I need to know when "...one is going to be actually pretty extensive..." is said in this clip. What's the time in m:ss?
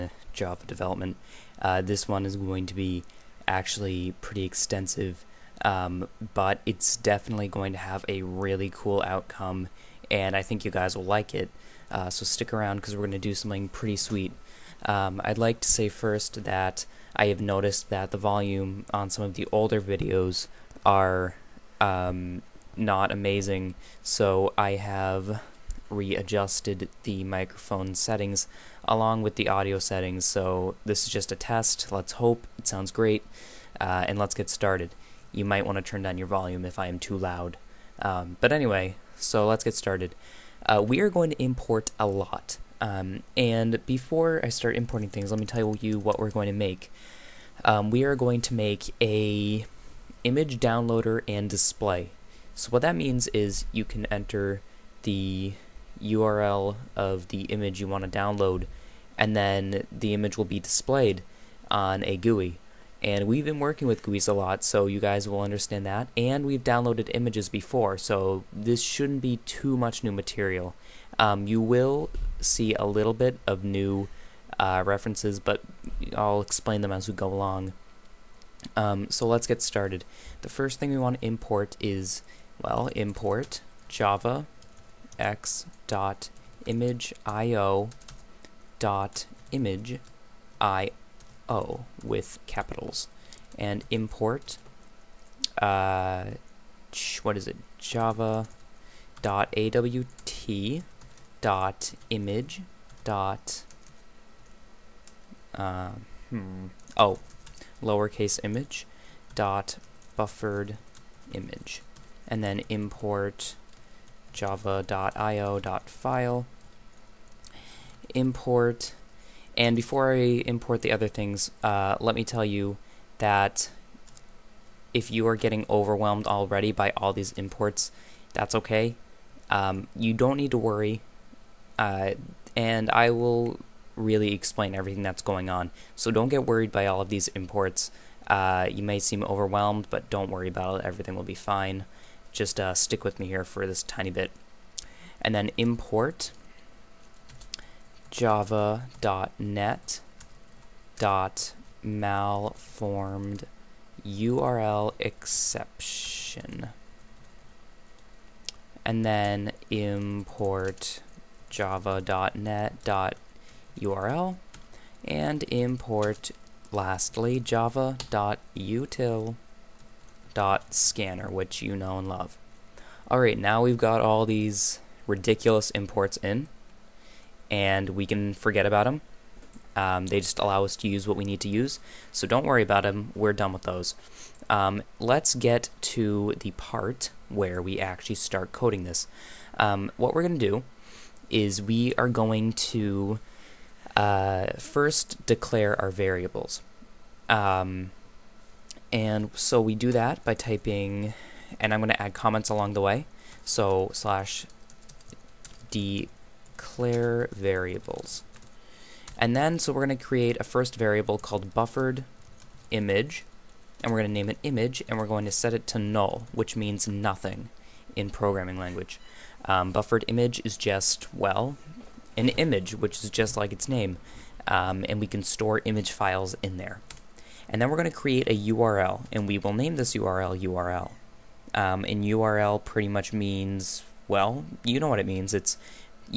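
0:02.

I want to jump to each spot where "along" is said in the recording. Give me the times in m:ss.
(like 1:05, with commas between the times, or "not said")
0:28, 1:17, 3:22.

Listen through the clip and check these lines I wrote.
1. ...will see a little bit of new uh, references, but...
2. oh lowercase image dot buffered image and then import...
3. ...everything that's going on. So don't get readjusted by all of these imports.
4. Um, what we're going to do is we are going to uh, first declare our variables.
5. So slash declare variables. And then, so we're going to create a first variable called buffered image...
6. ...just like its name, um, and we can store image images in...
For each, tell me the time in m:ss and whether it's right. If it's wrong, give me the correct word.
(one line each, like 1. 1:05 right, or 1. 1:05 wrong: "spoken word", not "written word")
1. 1:11 right
2. 1:46 right
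3. 2:14 wrong: "worried", not "readjusted"
4. 3:09 right
5. 3:23 right
6. 3:43 wrong: "files", not "images".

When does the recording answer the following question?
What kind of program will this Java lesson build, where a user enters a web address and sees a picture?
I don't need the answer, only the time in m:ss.
0:50.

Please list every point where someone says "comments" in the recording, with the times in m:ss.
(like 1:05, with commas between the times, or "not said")
3:22.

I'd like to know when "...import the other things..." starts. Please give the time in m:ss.
2:00.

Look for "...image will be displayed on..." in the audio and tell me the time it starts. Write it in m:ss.
1:00.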